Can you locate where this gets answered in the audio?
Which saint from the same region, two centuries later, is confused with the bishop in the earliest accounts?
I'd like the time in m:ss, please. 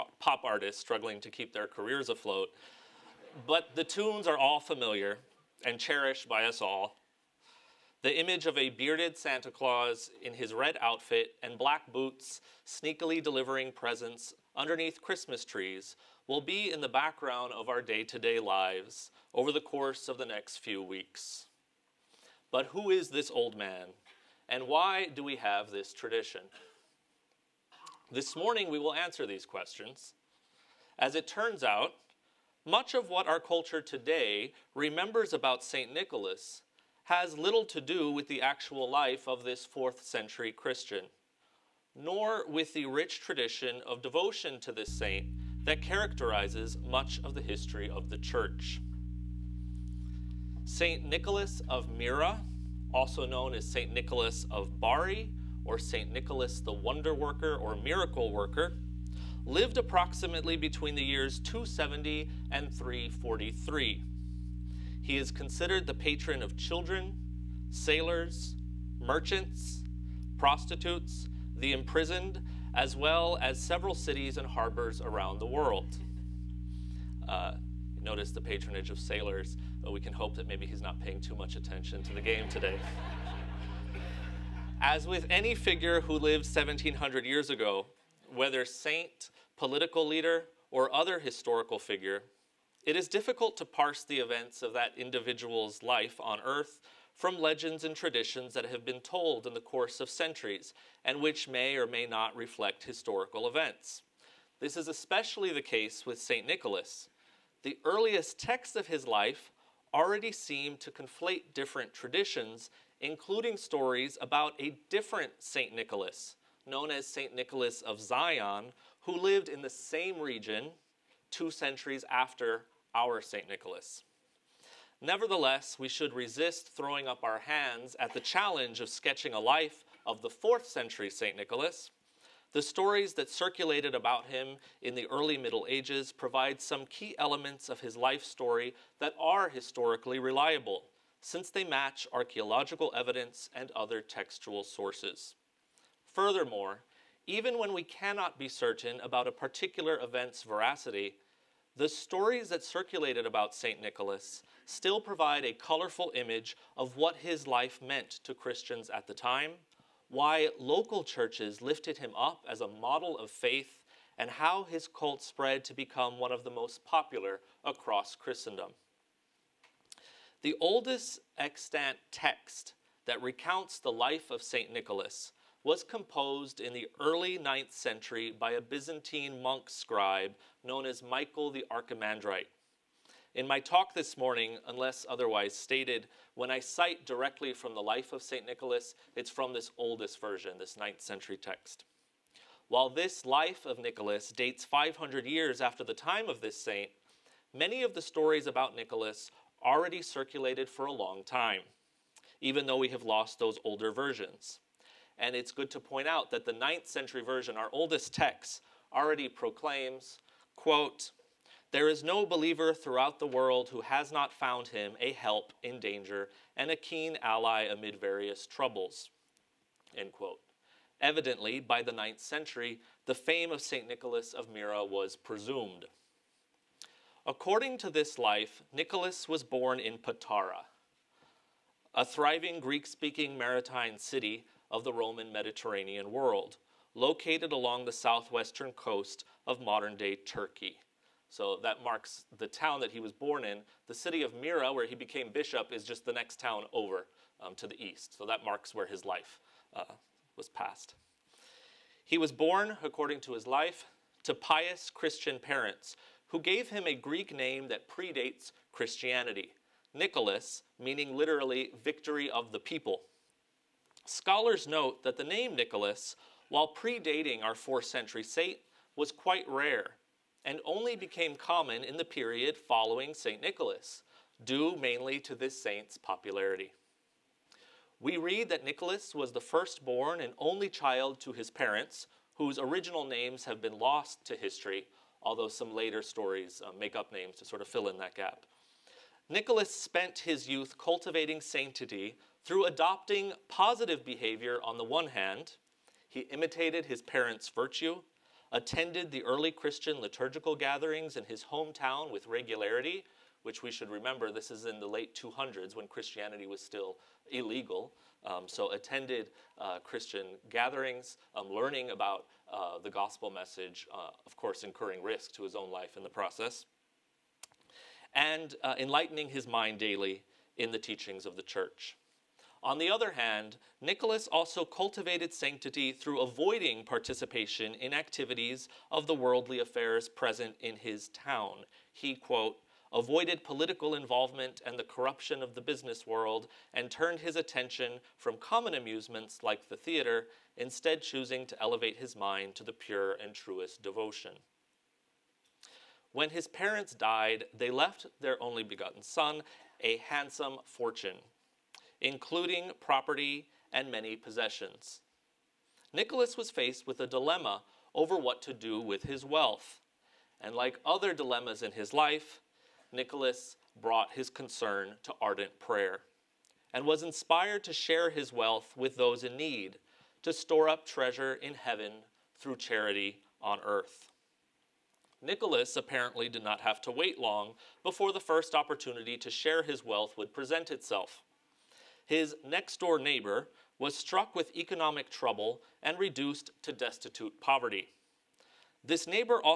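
1:57.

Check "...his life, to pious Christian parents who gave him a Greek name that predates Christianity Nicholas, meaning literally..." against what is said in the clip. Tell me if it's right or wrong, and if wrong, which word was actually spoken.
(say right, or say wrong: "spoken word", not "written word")
right.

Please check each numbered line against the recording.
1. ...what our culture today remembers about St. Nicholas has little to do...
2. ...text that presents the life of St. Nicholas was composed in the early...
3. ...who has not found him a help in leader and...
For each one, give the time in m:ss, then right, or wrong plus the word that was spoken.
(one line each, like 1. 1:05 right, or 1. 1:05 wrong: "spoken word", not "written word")
1. 0:33 right
2. 2:52 wrong: "recounts", not "presents"
3. 3:33 wrong: "danger", not "leader".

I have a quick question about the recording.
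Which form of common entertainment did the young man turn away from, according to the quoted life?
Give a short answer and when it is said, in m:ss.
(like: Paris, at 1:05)
the theater, at 5:39.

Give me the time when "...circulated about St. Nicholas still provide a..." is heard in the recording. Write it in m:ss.
2:32.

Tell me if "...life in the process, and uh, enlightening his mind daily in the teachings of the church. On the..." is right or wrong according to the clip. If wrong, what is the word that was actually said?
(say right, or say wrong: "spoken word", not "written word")
right.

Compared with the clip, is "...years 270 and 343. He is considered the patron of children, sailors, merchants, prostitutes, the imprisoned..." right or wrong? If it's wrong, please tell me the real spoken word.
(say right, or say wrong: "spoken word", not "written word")
right.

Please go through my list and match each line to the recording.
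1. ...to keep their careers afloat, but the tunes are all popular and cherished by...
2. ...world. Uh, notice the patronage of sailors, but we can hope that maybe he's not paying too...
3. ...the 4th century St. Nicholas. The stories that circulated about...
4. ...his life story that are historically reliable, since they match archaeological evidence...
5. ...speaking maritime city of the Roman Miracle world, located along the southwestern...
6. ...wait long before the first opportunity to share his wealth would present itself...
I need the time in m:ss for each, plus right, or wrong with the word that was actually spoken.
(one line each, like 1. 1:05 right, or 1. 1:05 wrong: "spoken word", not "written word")
1. 0:01 wrong: "familiar", not "popular"
2. 1:15 right
3. 2:10 right
4. 2:17 right
5. 3:52 wrong: "Mediterranean", not "Miracle"
6. 6:16 right.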